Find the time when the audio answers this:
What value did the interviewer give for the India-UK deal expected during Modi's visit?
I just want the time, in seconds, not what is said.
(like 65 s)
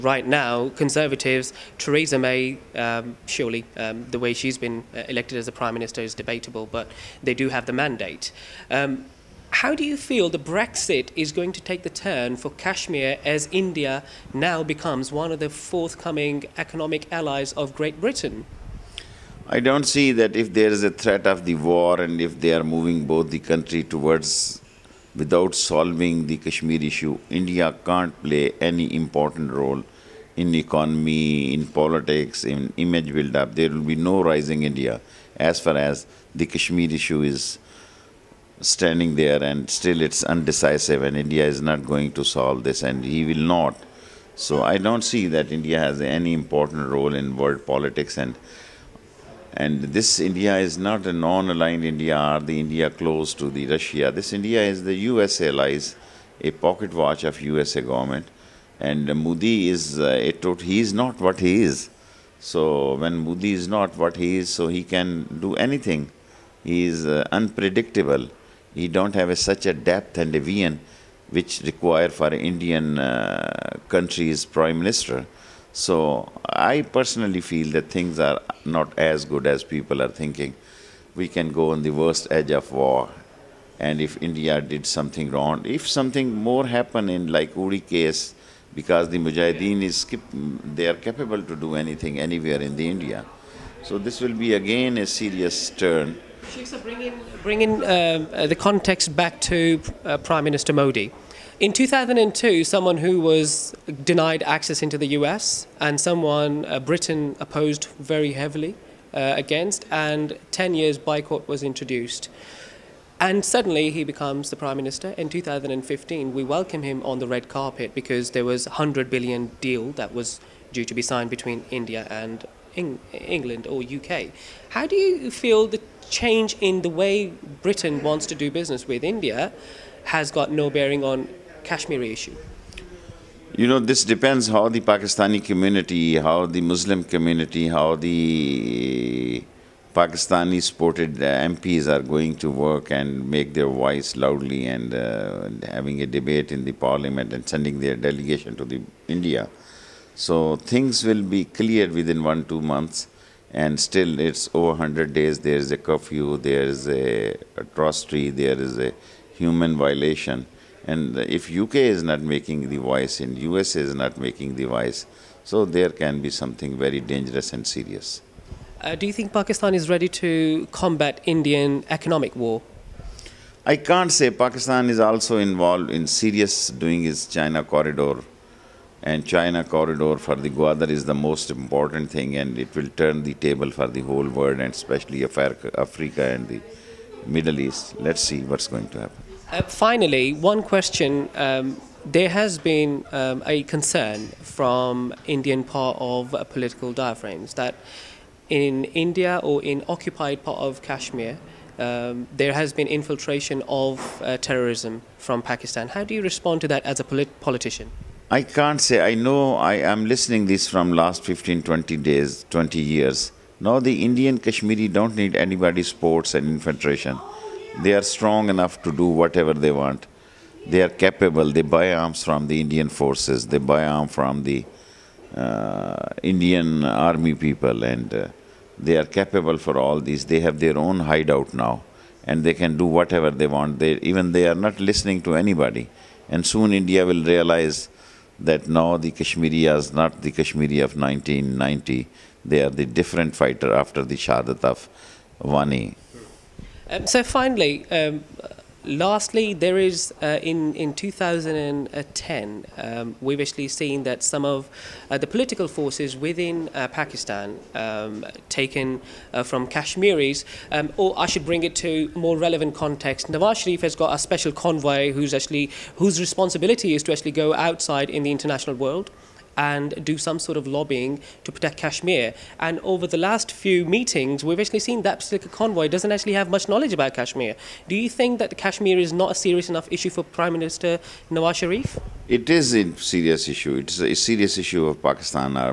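118 s.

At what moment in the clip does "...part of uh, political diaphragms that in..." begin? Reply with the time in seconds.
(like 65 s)
195 s.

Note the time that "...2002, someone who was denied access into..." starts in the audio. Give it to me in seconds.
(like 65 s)
101 s.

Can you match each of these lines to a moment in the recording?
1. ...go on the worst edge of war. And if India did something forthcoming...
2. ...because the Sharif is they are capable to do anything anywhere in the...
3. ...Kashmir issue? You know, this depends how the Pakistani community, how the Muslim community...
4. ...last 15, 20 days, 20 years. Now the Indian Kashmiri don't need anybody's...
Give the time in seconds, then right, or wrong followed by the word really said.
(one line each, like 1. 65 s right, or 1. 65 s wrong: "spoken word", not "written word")
1. 81 s wrong: "wrong", not "forthcoming"
2. 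88 s wrong: "Mujahideen", not "Sharif"
3. 131 s right
4. 210 s right.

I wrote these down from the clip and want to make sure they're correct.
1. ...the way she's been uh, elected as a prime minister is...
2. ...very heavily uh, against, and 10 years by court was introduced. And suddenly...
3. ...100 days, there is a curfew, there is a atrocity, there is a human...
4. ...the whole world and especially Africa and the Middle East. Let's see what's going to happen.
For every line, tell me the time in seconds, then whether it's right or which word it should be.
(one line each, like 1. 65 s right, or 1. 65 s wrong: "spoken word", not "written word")
1. 4 s right
2. 107 s right
3. 154 s right
4. 183 s right.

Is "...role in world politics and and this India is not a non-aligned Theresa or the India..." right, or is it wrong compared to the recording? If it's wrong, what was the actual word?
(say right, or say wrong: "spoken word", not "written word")
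wrong: "India", not "Theresa".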